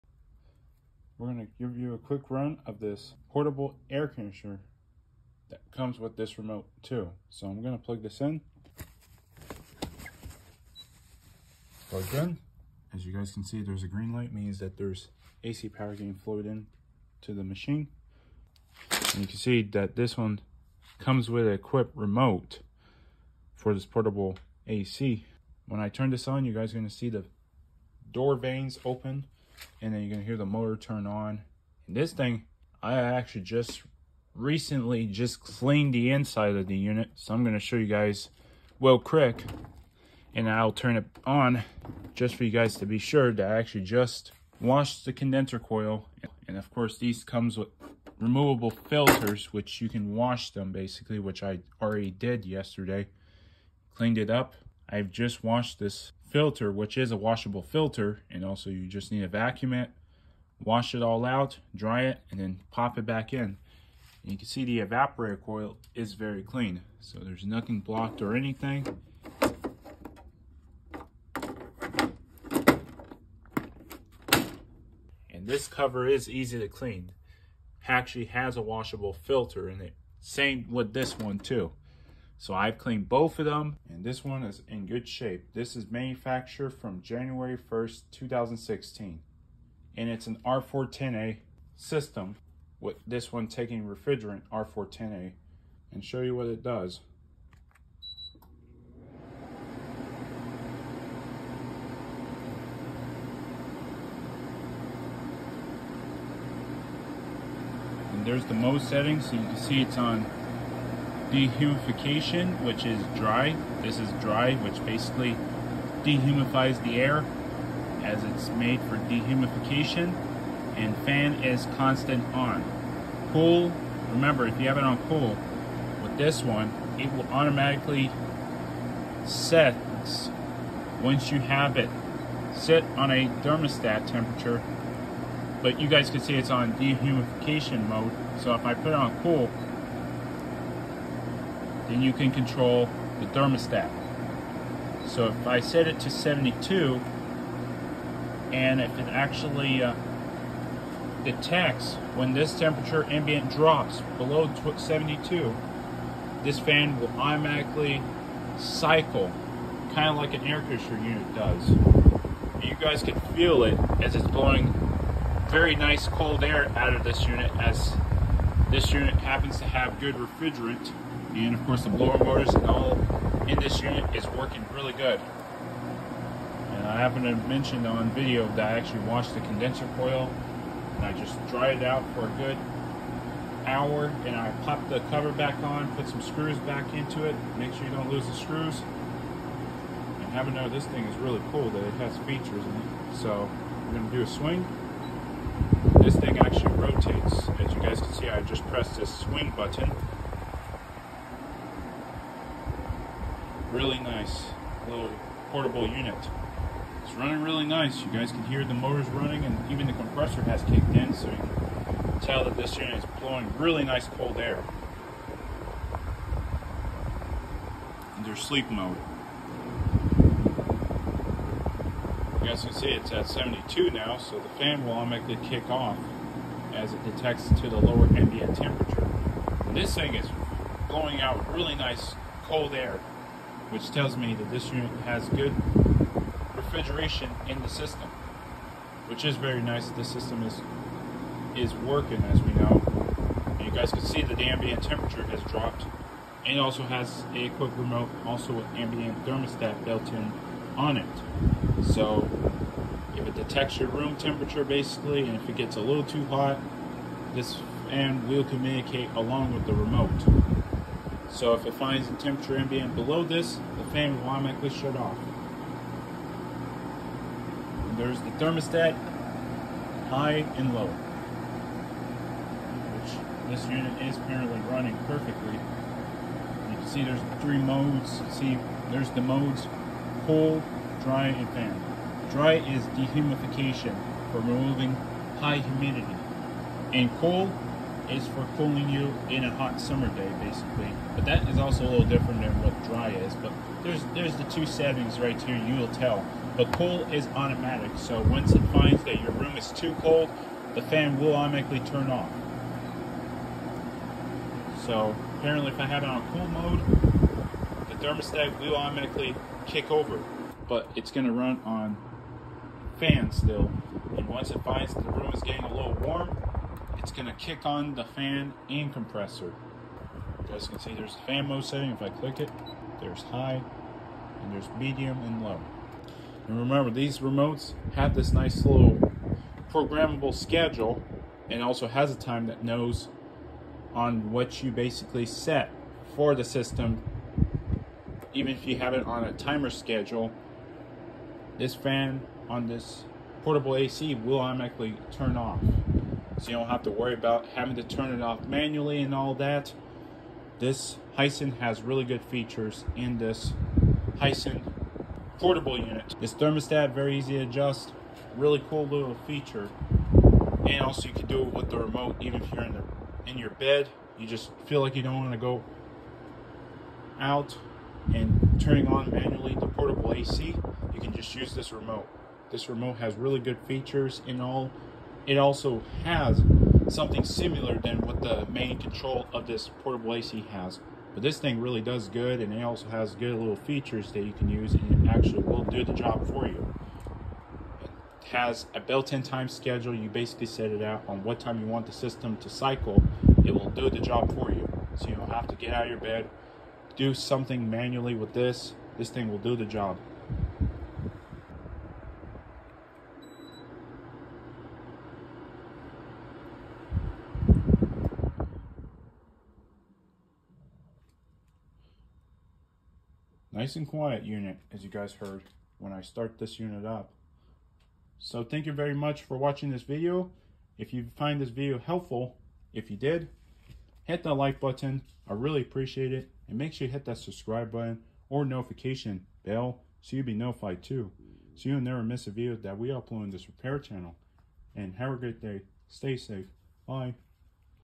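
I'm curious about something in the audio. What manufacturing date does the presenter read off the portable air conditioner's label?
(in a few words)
January 1st, 2016.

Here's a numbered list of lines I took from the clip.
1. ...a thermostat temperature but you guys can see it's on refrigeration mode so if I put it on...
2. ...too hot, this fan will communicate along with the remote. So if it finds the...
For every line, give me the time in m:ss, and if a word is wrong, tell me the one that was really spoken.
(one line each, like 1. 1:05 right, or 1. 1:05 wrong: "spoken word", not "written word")
1. 2:13 wrong: "dehumidification", not "refrigeration"
2. 4:16 right.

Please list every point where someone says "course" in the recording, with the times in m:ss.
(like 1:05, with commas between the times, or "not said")
0:46, 2:51.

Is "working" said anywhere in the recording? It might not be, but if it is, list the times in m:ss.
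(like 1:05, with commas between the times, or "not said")
2:54, 4:01.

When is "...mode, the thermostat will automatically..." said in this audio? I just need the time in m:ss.
5:06.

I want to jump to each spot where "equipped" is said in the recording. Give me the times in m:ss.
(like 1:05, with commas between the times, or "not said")
0:21.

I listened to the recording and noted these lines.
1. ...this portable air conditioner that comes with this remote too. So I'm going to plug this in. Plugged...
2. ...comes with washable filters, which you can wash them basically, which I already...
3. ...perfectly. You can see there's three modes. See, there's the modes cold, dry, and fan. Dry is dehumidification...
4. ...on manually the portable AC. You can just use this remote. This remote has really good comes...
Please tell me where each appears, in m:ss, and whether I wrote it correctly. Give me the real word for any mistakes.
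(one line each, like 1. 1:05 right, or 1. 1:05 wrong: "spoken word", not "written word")
1. 0:02 right
2. 0:47 wrong: "removable", not "washable"
3. 4:35 right
4. 6:08 wrong: "features", not "comes".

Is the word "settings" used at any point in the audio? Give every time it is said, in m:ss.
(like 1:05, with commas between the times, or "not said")
1:48, 4:54, 5:21.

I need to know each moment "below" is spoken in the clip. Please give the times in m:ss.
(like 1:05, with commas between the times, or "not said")
2:34, 4:22.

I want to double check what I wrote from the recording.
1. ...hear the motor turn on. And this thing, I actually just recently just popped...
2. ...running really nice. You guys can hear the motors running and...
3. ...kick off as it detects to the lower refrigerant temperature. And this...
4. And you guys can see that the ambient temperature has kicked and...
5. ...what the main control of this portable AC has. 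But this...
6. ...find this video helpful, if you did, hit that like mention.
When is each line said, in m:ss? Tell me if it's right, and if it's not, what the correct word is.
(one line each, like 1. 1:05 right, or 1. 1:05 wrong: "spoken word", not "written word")
1. 0:30 wrong: "cleaned", not "popped"
2. 3:27 right
3. 3:45 wrong: "ambient", not "refrigerant"
4. 4:03 wrong: "dropped", not "kicked"
5. 6:18 right
6. 7:01 wrong: "button", not "mention".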